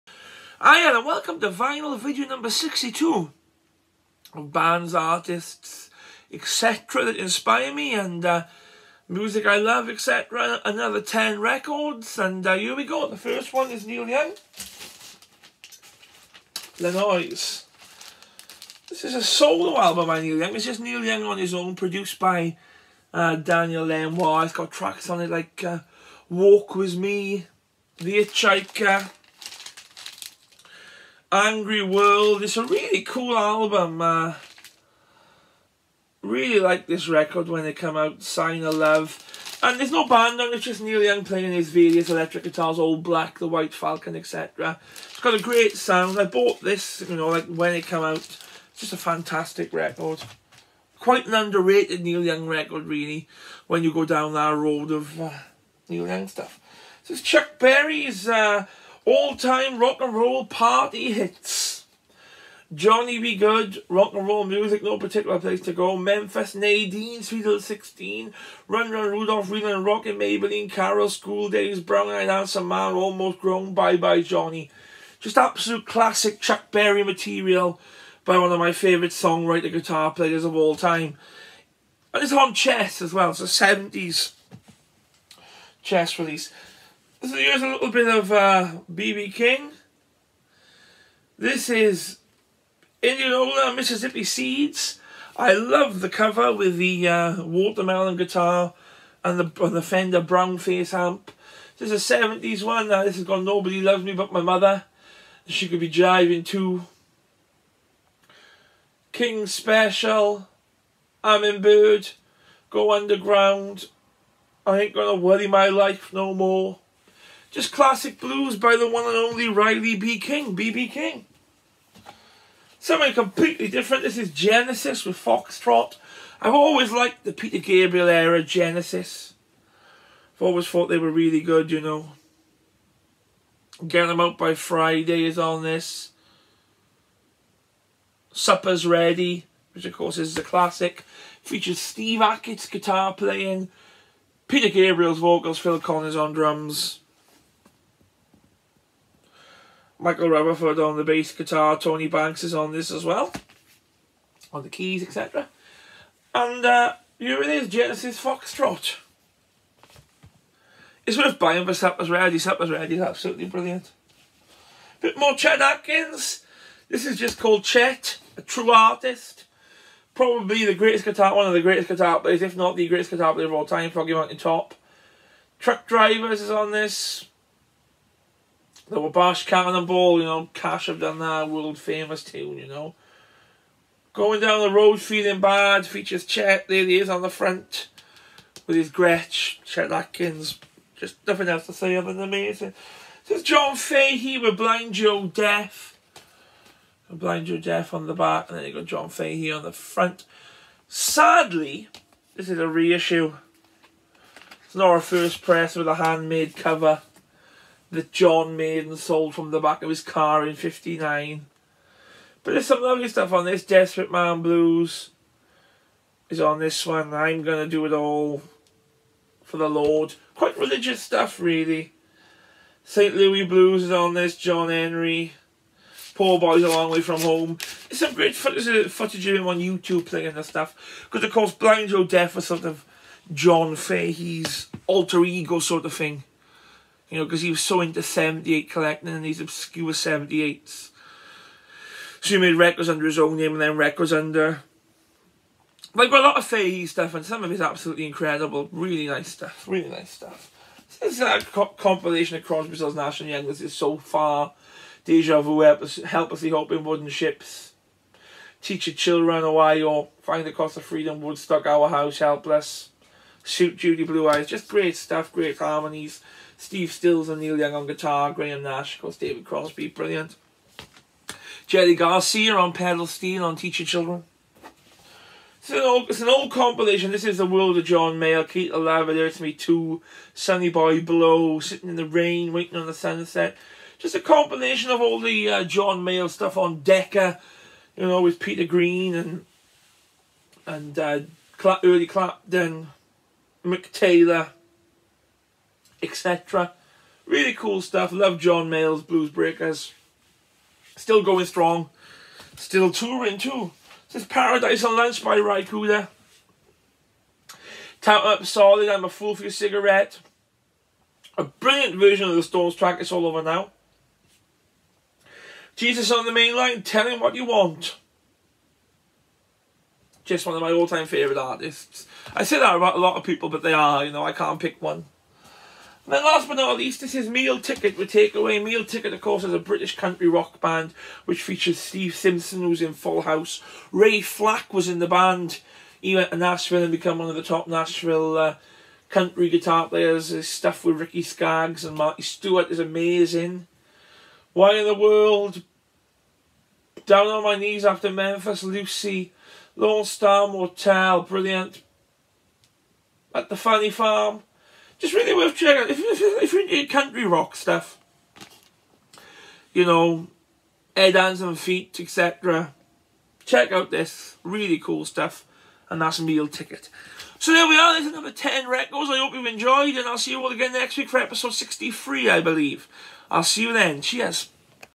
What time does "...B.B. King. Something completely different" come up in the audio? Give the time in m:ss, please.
2:00.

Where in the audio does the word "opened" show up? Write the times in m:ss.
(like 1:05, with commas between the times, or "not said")
not said.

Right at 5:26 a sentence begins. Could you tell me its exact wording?
Then last but not least, this is Meal Ticket with Takeaway.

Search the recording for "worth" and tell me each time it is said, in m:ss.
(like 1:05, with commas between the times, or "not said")
2:41, 5:55.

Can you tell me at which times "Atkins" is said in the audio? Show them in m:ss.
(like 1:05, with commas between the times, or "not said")
2:45, 3:09.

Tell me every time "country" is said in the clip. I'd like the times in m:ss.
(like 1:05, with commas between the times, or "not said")
5:29, 5:39, 5:56.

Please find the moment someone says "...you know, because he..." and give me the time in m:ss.
3:57.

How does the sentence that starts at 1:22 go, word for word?
And it's on Chess as well, so 70s Chess release.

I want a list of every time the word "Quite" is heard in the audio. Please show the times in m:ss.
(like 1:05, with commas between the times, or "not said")
0:50, 3:40.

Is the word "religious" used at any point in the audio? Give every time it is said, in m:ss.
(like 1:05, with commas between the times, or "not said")
3:40.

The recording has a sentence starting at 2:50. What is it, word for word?
Probably the greatest guitar, one of the greatest guitar players, if not the greatest guitar player of all time, Foggy Mountain Top.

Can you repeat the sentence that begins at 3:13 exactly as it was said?
There's John Fahey with Blind Joe Death.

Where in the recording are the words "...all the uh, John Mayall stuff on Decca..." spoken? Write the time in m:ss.
4:45.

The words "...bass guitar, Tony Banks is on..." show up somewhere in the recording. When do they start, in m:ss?
2:31.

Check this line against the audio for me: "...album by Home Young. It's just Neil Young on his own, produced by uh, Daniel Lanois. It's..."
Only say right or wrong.
wrong.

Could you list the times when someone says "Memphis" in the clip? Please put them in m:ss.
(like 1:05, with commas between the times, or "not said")
1:05, 5:48.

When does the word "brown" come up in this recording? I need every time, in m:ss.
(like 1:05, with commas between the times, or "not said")
1:11, 1:40.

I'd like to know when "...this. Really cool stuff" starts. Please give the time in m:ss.
6:03.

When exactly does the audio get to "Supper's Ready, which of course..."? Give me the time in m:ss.
2:18.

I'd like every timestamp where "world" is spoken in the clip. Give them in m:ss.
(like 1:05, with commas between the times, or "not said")
0:31, 3:01, 4:37, 5:44.